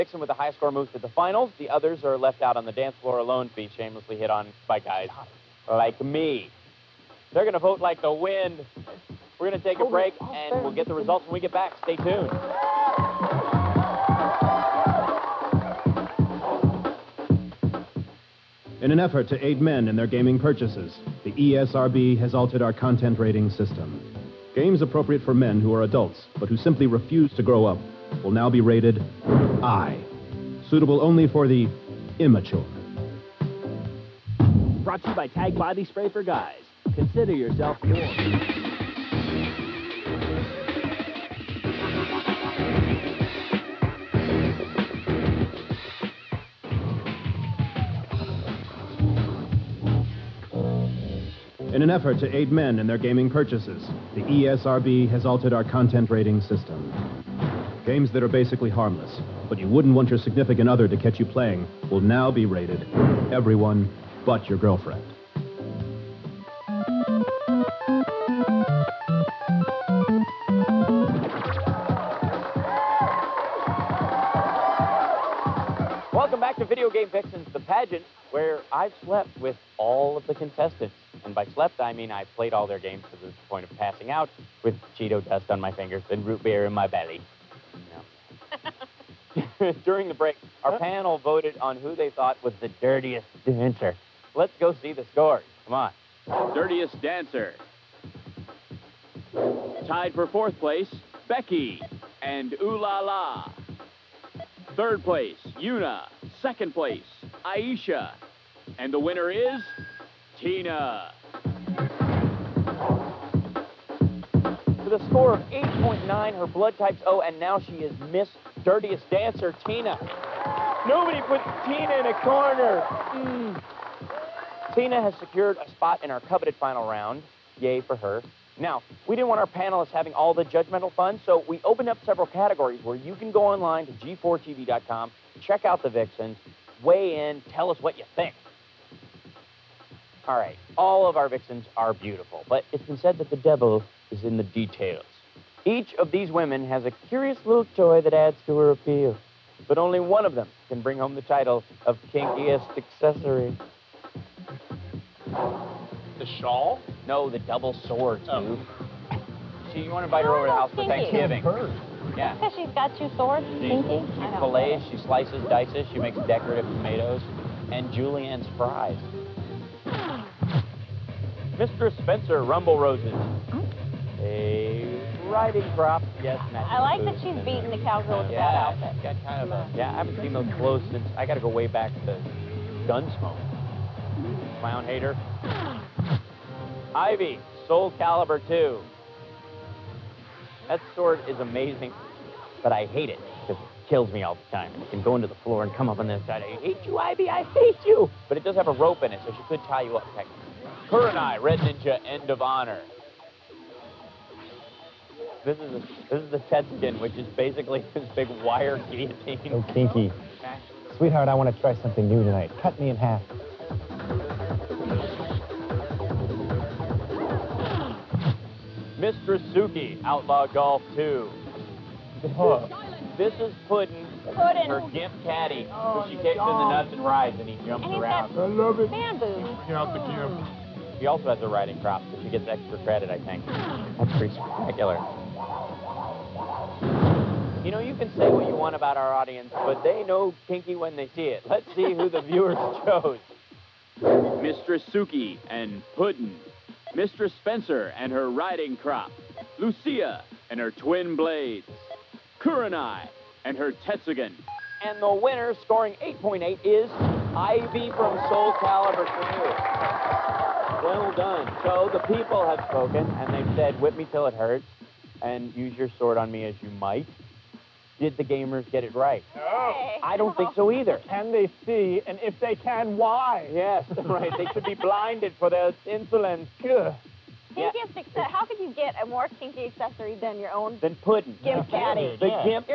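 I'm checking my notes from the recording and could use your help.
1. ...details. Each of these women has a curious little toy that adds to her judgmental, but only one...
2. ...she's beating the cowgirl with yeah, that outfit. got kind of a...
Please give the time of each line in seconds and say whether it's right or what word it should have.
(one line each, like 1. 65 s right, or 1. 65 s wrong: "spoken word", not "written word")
1. 144 s wrong: "appeal", not "judgmental"
2. 177 s right.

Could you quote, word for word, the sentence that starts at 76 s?
Welcome back to Video Game Vixens, the pageant where I've slept with all of the contestants.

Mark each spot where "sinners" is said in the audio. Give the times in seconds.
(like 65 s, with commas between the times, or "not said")
not said.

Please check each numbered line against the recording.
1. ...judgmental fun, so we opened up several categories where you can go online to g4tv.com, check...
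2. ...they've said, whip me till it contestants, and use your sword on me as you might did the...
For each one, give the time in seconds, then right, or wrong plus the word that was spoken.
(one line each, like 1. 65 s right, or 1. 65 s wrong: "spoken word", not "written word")
1. 130 s right
2. 263 s wrong: "hurts", not "contestants".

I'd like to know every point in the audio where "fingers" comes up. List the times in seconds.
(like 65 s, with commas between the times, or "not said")
85 s.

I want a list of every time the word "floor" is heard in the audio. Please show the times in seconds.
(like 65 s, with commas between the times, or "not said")
2 s, 195 s.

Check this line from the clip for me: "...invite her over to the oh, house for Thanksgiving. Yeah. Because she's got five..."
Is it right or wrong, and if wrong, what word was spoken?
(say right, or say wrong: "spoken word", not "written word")
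wrong: "two", not "five".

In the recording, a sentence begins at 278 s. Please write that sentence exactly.
How could you get a more kinky accessory than your own?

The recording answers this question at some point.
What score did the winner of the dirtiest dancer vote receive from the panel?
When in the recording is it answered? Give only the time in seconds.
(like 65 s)
115 s.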